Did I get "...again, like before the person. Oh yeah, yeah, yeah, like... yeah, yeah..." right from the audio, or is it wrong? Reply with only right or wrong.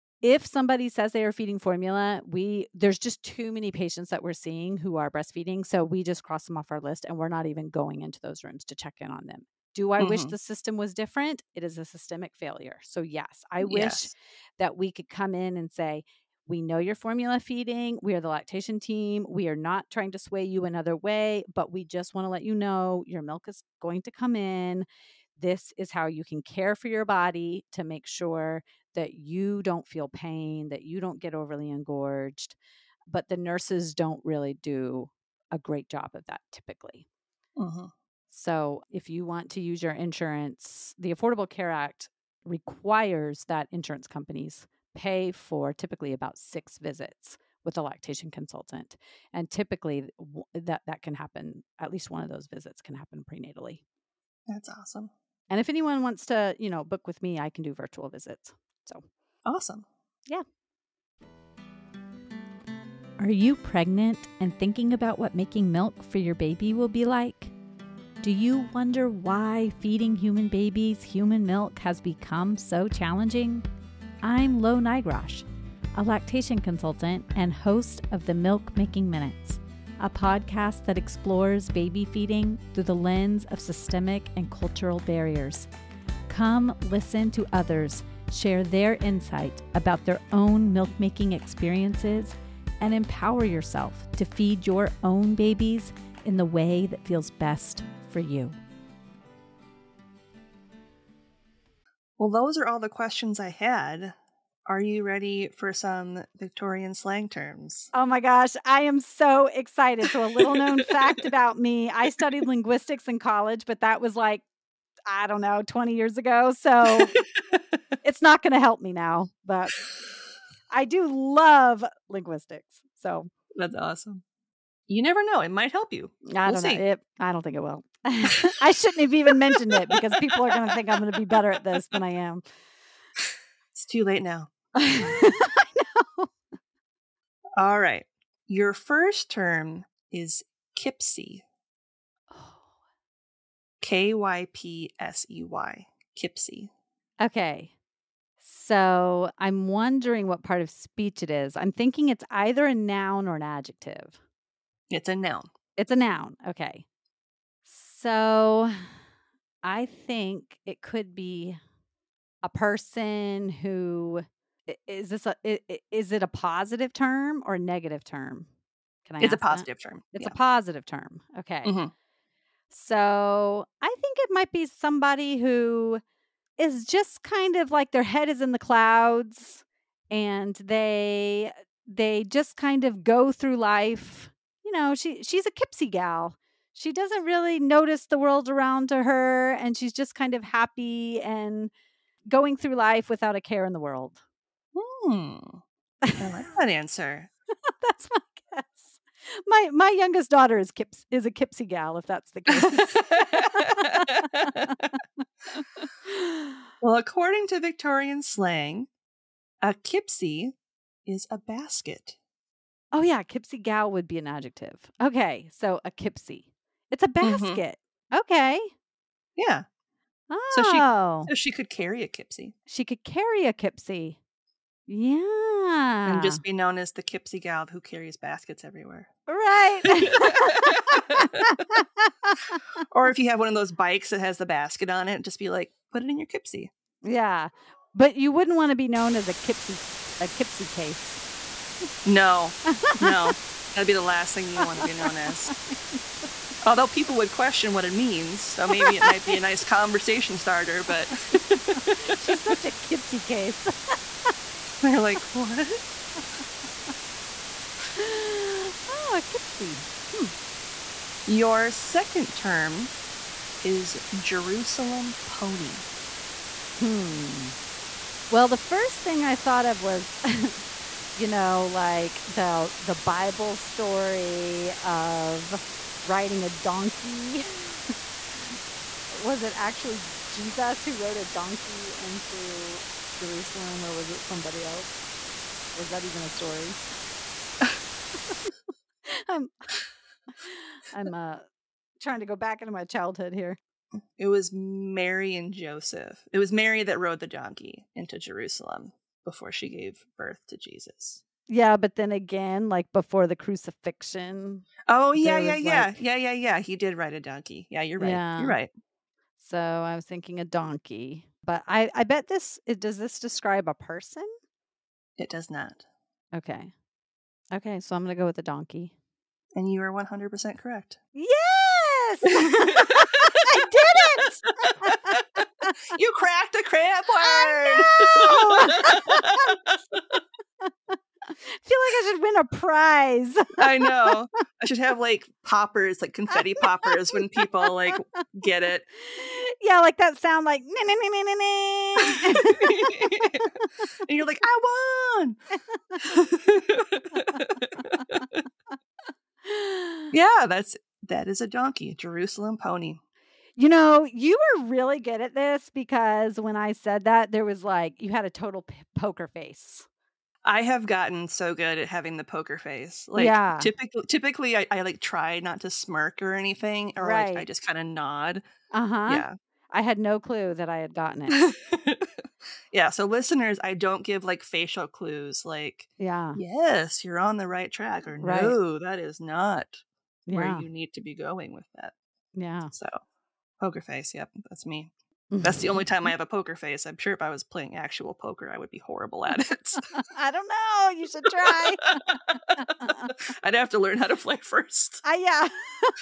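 wrong.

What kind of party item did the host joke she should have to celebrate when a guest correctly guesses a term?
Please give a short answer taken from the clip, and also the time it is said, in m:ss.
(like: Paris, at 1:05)
Confetti poppers, at 5:36.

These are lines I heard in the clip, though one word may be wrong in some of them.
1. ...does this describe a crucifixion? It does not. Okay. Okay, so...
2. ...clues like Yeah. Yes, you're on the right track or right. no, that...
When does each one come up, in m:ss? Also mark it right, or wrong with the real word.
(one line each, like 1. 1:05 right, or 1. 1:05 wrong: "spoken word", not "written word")
1. 5:12 wrong: "person", not "crucifixion"
2. 6:14 right.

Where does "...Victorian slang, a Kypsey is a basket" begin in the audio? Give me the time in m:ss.
3:27.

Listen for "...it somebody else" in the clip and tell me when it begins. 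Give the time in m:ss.
4:44.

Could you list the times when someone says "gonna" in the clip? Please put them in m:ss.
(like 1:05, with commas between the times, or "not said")
5:18.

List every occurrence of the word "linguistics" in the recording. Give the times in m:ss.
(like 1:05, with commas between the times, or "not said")
1:52, 2:02.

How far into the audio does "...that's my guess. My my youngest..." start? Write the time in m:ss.
3:17.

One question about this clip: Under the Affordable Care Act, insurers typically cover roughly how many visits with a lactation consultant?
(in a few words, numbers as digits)
6.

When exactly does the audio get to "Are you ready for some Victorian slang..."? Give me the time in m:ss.
1:44.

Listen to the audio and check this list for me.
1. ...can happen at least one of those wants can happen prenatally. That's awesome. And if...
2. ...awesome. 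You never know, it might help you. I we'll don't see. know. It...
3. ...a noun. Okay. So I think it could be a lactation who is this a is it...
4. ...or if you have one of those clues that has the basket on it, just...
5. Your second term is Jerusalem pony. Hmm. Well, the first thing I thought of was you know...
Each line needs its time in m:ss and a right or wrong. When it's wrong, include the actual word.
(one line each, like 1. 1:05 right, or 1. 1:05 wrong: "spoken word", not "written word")
1. 0:51 wrong: "visits", not "wants"
2. 2:03 right
3. 2:35 wrong: "person", not "lactation"
4. 3:52 wrong: "bikes", not "clues"
5. 4:21 right.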